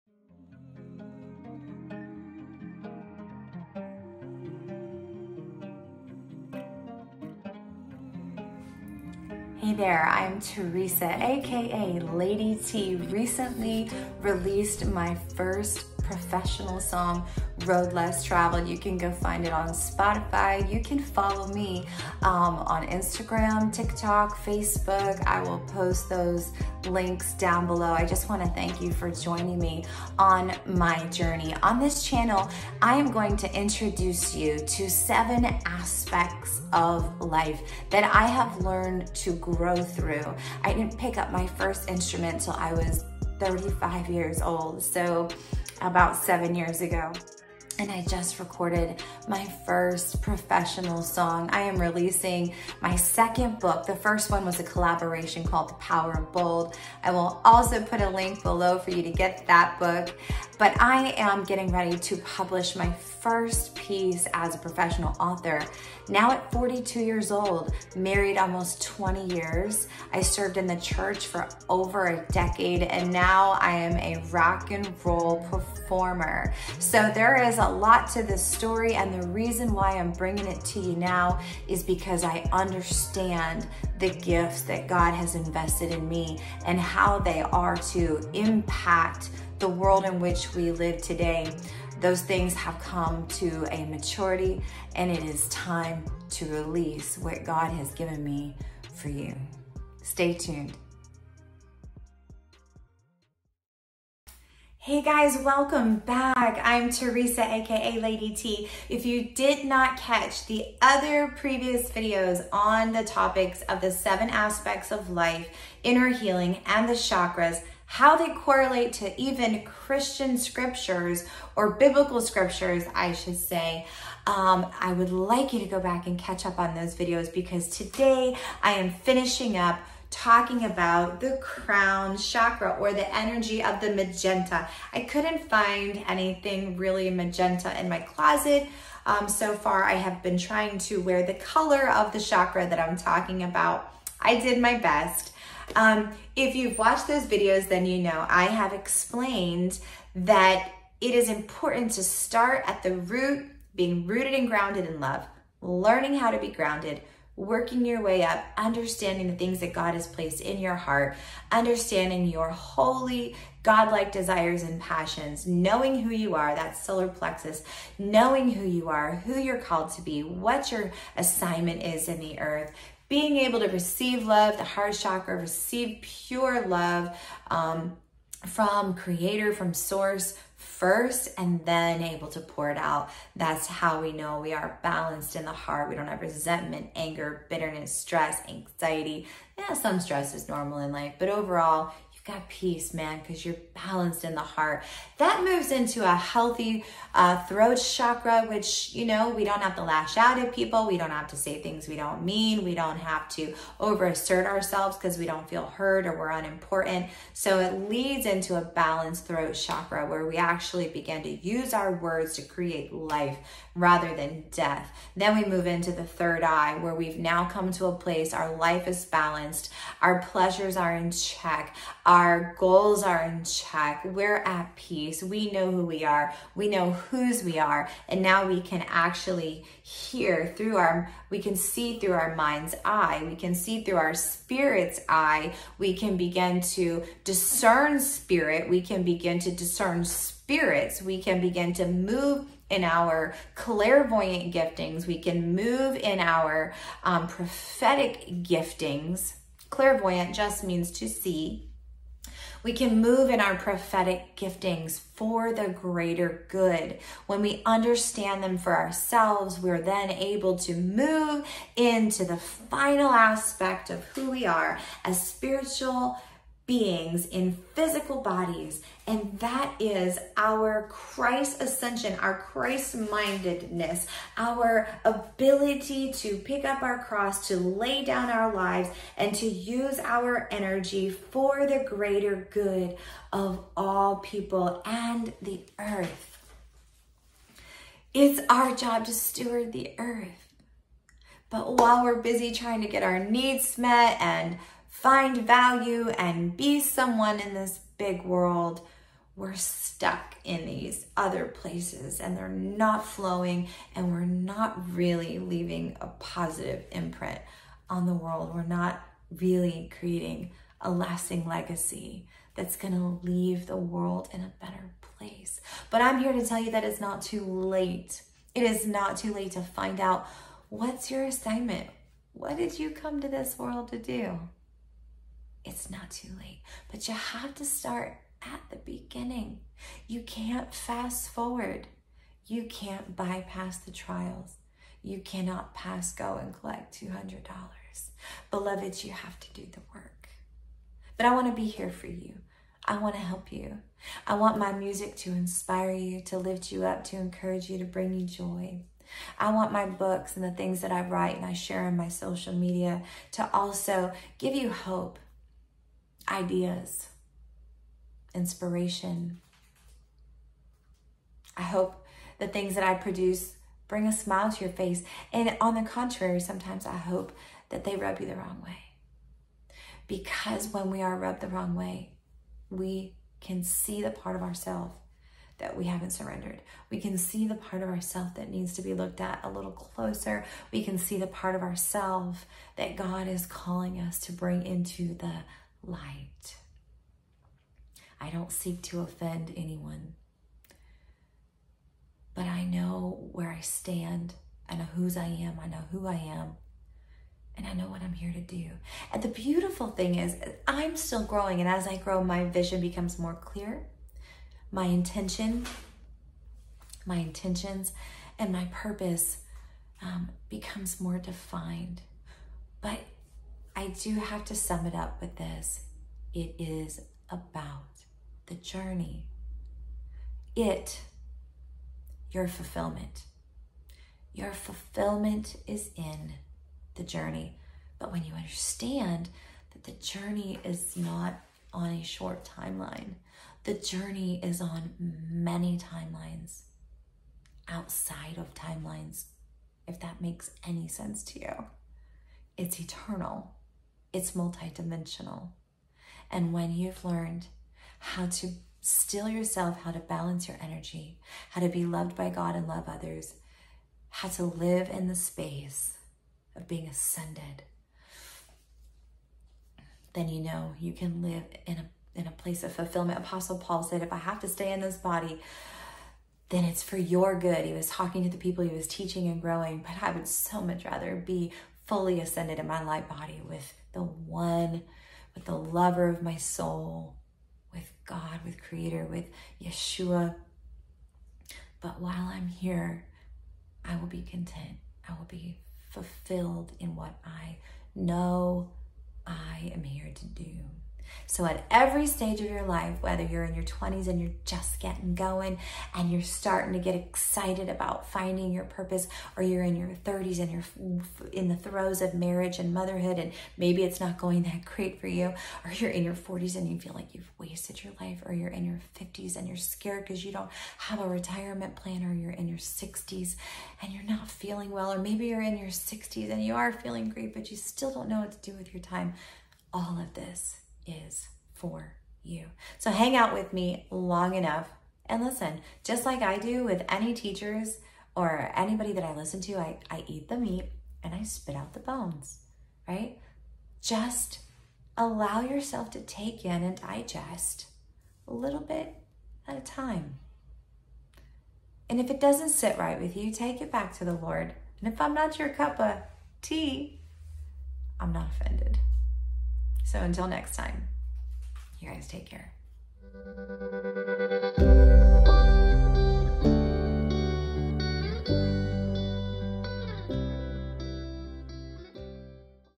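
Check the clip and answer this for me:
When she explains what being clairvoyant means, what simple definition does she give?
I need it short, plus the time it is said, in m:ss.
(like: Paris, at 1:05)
to see, at 4:10.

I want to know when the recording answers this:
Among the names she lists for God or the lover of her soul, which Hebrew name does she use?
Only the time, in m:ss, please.
7:59.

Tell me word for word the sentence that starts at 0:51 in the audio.
I am releasing my second book.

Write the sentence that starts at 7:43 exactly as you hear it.
Apostle Paul said, if I have to stay in this body, then it's for your good.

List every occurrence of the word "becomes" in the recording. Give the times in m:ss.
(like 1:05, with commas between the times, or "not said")
6:42, 6:50.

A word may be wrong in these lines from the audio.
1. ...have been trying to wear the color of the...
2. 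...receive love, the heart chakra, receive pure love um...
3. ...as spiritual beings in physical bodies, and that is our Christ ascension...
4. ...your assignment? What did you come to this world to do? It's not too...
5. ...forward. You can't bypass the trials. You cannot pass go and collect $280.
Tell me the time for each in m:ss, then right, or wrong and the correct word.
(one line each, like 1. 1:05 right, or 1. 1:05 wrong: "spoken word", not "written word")
1. 2:19 right
2. 2:53 right
3. 4:25 right
4. 5:21 right
5. 5:31 wrong: "200", not "280".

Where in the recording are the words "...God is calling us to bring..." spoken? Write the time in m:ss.
6:22.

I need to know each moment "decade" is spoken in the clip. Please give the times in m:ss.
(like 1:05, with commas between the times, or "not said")
1:12.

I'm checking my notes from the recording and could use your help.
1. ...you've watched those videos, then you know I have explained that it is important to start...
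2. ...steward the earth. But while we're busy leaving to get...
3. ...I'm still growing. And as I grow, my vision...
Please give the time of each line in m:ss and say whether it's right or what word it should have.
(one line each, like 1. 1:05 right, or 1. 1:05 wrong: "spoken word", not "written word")
1. 2:26 right
2. 4:49 wrong: "trying", not "leaving"
3. 6:40 right.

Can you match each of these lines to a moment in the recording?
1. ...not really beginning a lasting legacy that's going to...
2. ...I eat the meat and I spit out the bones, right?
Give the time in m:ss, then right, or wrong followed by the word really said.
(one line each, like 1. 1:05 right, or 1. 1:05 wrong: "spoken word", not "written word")
1. 5:08 wrong: "creating", not "beginning"
2. 8:49 right.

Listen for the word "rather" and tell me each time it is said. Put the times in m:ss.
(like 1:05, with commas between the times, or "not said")
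3:33, 7:50.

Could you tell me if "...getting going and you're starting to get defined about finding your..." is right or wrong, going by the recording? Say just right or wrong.
wrong.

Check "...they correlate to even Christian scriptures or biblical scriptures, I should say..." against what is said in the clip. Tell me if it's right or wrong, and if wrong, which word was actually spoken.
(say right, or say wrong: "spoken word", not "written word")
right.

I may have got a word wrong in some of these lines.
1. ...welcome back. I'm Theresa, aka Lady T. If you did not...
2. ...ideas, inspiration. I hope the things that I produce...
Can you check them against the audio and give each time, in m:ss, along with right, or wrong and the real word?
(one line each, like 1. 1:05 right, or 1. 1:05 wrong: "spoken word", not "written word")
1. 1:45 right
2. 5:56 right.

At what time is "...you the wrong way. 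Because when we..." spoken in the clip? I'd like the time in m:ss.
6:08.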